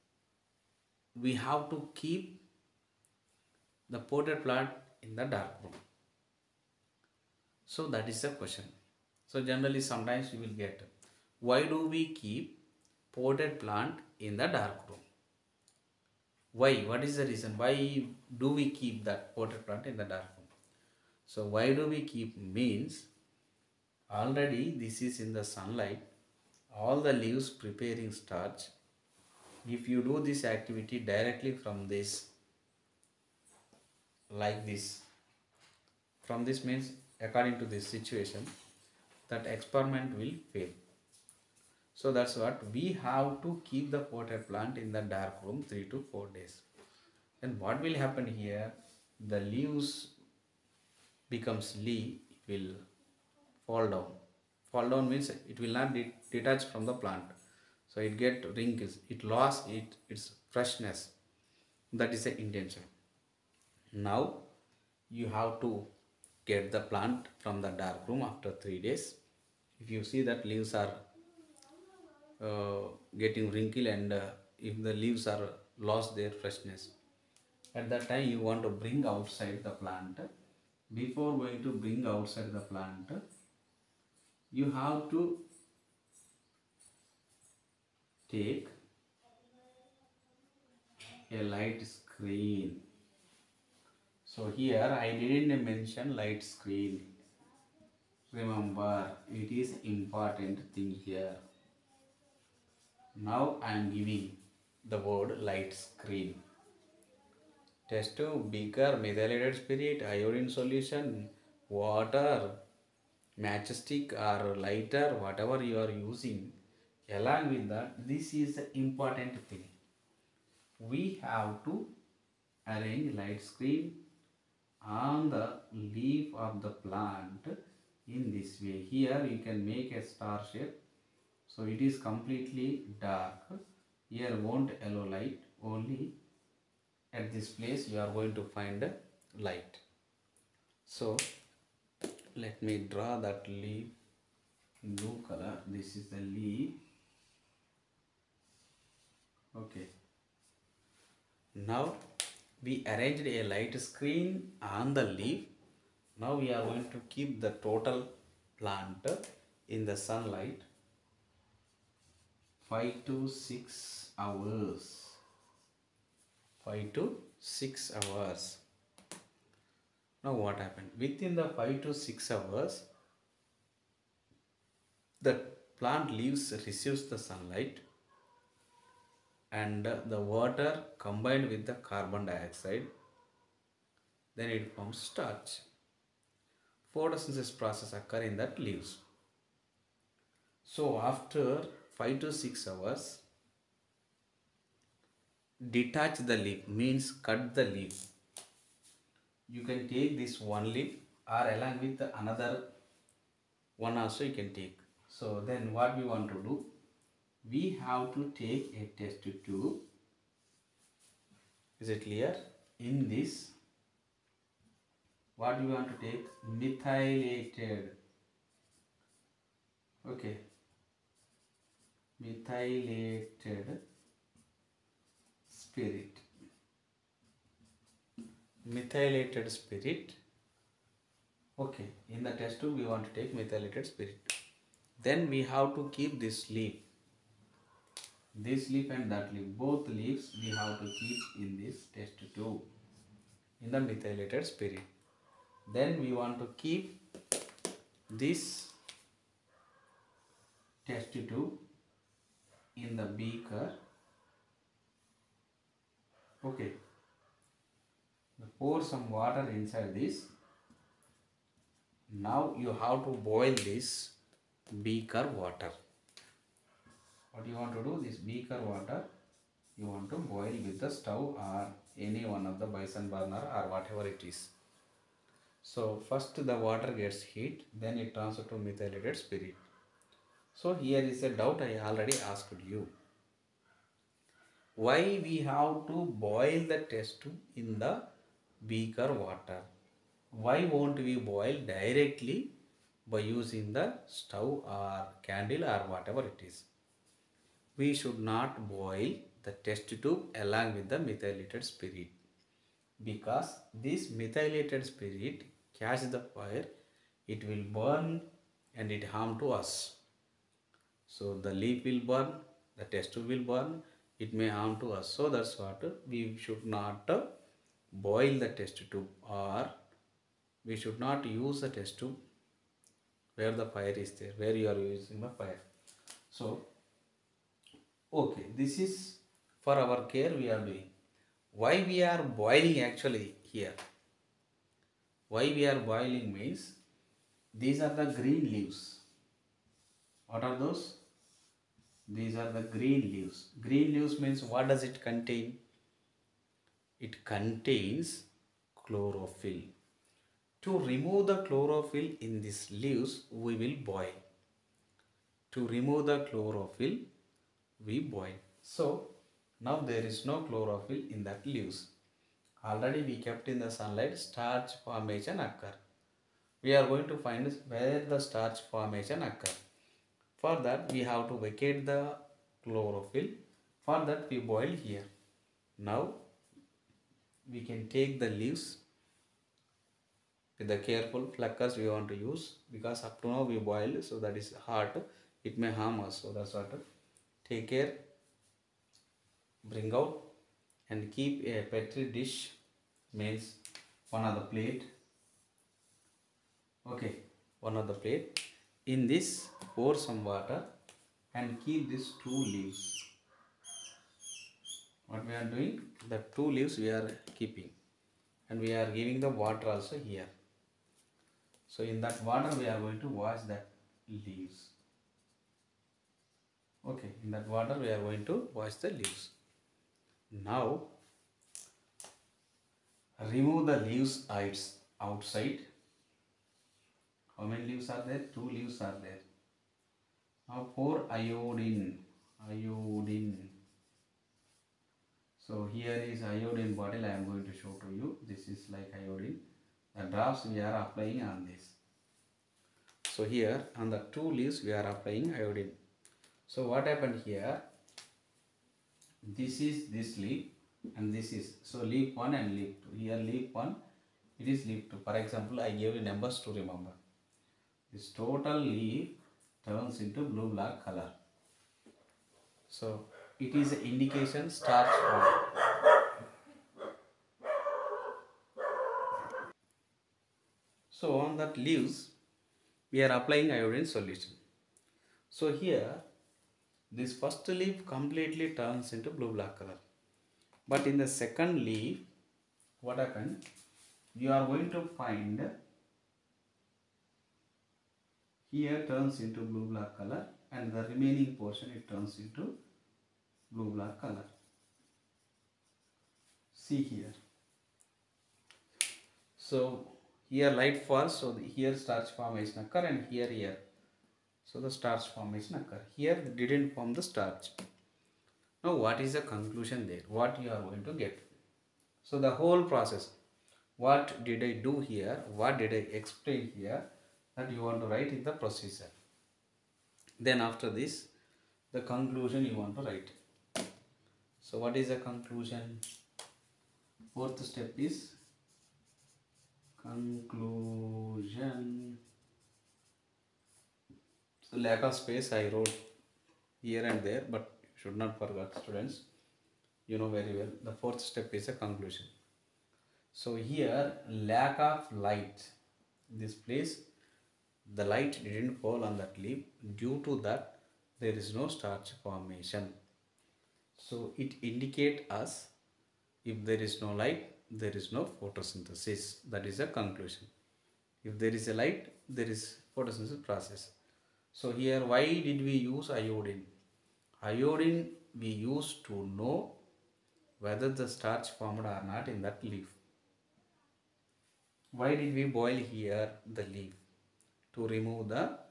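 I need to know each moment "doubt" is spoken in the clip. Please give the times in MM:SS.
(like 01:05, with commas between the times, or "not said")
04:41.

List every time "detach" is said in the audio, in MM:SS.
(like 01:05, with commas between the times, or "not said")
00:55, 03:15.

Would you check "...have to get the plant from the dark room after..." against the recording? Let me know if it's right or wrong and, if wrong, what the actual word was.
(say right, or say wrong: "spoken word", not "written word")
right.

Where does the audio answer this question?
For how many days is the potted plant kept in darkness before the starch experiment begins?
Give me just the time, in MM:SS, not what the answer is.
00:45.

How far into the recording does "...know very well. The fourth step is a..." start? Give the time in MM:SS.
08:59.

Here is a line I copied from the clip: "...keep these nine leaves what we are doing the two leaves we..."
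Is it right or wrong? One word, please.
wrong.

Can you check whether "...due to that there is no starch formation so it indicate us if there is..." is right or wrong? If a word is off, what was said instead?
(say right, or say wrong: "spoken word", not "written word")
right.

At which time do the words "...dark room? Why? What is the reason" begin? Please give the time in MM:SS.
00:14.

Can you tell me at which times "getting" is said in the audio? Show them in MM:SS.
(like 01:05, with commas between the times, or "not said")
01:13.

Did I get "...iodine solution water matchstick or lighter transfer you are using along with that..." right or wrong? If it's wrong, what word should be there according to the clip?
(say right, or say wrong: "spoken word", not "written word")
wrong: "whatever", not "transfer".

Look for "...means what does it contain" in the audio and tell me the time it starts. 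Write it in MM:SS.
05:44.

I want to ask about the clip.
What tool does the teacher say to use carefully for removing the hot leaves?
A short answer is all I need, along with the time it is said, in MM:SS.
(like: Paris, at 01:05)
pluckers, at 06:21.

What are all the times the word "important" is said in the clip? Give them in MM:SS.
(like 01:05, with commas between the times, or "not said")
01:39, 01:58.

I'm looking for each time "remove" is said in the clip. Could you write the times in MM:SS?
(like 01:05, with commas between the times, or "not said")
05:50, 05:55, 07:03, 09:37.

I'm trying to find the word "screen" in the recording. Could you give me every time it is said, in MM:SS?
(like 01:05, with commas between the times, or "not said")
01:31, 01:36, 01:45, 02:03, 02:33.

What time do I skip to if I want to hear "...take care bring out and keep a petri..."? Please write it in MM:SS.
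06:27.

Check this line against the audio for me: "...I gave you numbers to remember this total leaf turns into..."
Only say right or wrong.
right.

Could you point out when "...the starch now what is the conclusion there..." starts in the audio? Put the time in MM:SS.
08:26.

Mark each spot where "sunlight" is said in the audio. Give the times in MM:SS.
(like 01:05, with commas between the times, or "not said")
00:25, 02:39, 02:57, 06:03.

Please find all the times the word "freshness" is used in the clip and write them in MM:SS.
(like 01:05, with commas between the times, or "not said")
01:00, 01:16.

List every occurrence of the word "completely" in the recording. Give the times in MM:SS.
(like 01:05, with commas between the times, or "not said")
02:11, 07:57.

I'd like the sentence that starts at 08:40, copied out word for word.
Then after this, the conclusion you want to write.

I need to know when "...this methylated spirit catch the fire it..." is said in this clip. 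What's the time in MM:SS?
05:03.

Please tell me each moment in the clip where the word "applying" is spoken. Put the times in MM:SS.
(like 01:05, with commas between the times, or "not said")
07:20, 07:24, 07:53.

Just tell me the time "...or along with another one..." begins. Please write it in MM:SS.
03:21.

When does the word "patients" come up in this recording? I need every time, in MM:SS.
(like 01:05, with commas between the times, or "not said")
not said.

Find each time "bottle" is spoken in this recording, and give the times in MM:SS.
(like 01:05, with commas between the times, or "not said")
07:16.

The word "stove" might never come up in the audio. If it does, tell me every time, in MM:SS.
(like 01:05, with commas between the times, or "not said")
04:30, 04:54.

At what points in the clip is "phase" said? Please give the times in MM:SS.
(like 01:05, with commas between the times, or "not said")
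not said.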